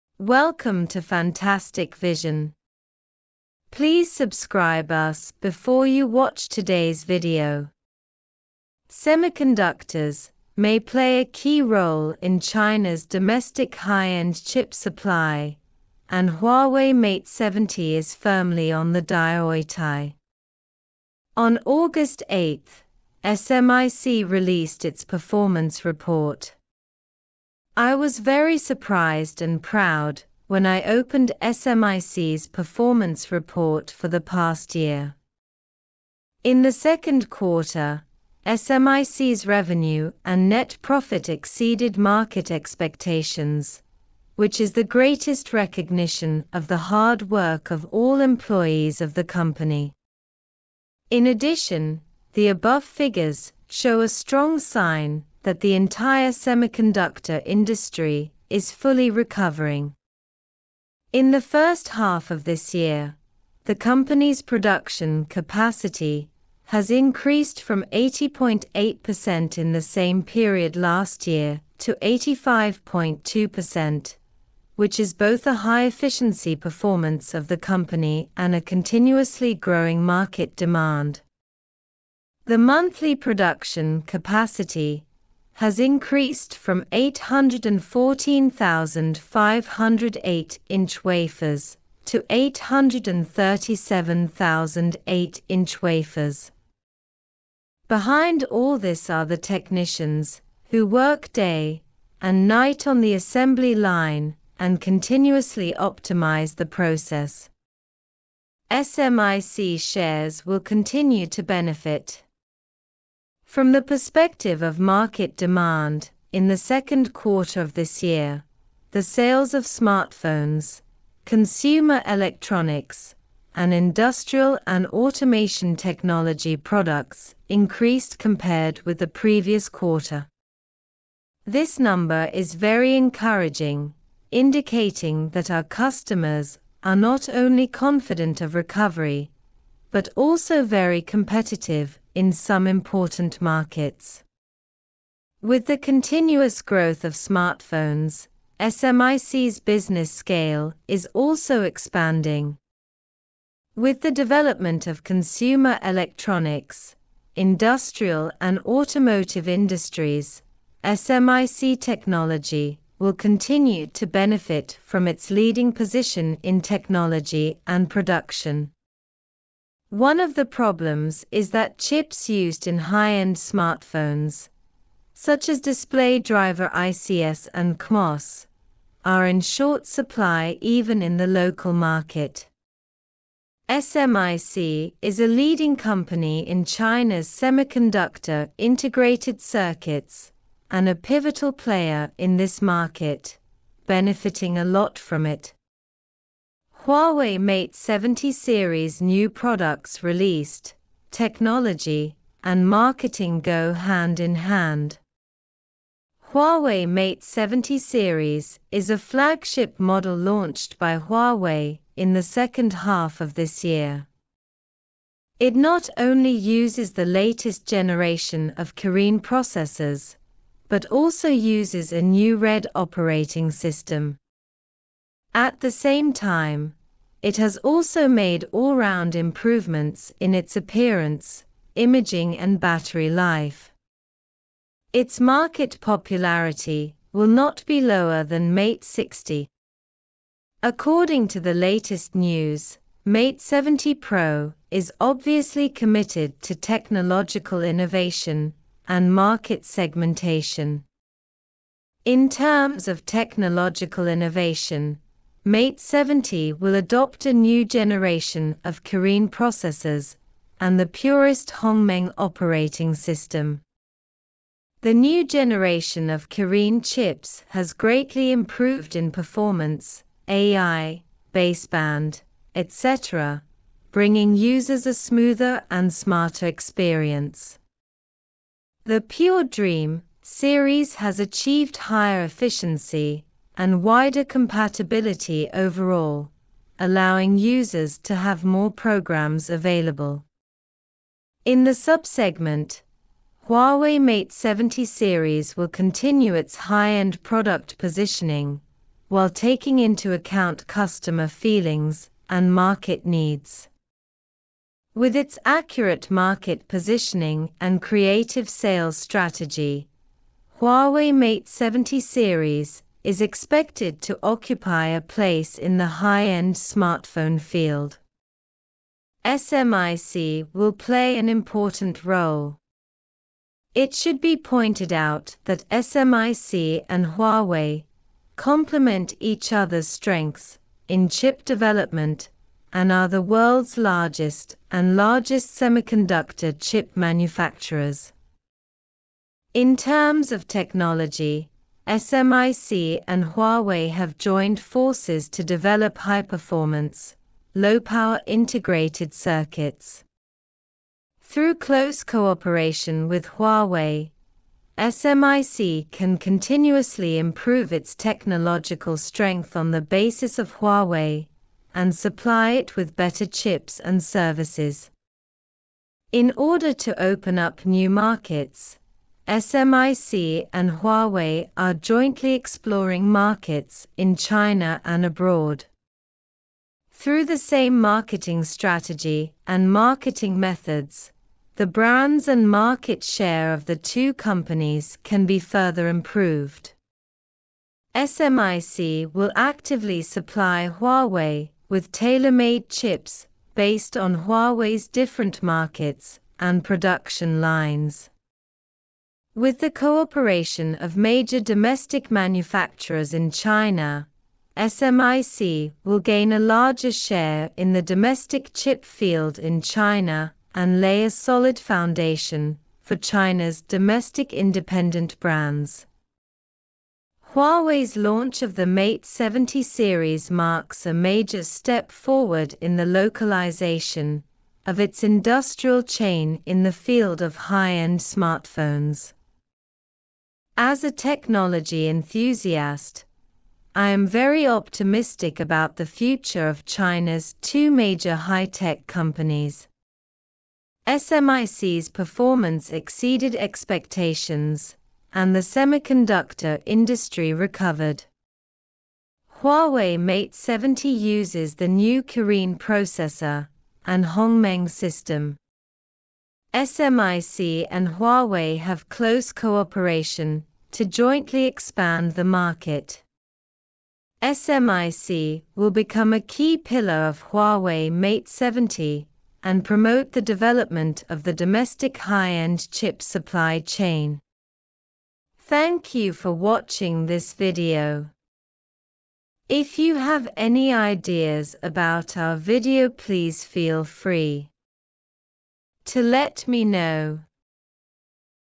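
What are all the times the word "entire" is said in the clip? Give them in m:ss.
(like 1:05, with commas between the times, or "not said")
0:55.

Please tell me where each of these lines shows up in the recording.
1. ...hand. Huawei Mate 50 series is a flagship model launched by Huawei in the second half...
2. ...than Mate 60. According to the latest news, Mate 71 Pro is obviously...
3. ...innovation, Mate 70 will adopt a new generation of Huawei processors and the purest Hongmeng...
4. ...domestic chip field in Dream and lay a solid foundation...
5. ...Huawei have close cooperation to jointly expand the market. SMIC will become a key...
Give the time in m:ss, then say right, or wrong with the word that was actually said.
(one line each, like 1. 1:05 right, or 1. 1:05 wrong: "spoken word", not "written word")
1. 3:24 wrong: "70", not "50"
2. 3:58 wrong: "70", not "71"
3. 4:14 wrong: "Kirin", not "Huawei"
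4. 6:47 wrong: "China", not "Dream"
5. 7:37 right.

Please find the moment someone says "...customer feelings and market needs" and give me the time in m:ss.
5:00.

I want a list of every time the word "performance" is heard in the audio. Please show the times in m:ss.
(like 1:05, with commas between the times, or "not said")
0:25, 0:32, 1:16, 4:29, 5:45, 7:21.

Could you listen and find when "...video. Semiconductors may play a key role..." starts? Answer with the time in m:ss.
0:07.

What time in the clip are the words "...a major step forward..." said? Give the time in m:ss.
7:00.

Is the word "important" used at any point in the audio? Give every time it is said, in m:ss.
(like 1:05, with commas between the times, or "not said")
2:22, 5:21.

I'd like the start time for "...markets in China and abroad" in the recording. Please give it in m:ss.
6:13.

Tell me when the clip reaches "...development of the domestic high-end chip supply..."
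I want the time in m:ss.
7:50.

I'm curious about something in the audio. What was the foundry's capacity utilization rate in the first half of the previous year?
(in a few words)
80.8%.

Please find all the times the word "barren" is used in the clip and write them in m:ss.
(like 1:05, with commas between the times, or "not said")
not said.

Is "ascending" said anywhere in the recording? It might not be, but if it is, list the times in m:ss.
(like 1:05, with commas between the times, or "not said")
not said.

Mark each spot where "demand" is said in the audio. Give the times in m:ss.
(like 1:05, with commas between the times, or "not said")
1:20, 1:55.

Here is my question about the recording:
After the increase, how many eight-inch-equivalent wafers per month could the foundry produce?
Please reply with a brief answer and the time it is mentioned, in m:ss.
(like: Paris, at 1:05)
837,008, at 1:32.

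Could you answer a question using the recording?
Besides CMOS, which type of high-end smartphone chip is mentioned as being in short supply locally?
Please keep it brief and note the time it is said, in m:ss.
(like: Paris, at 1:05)
display driver ICs, at 2:55.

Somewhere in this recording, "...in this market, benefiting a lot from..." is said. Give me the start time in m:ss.
3:12.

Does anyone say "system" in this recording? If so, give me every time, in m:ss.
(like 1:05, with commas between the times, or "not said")
3:43, 4:22, 7:34.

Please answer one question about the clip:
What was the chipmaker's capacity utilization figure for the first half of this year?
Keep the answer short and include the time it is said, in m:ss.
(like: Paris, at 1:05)
85.2%, at 1:11.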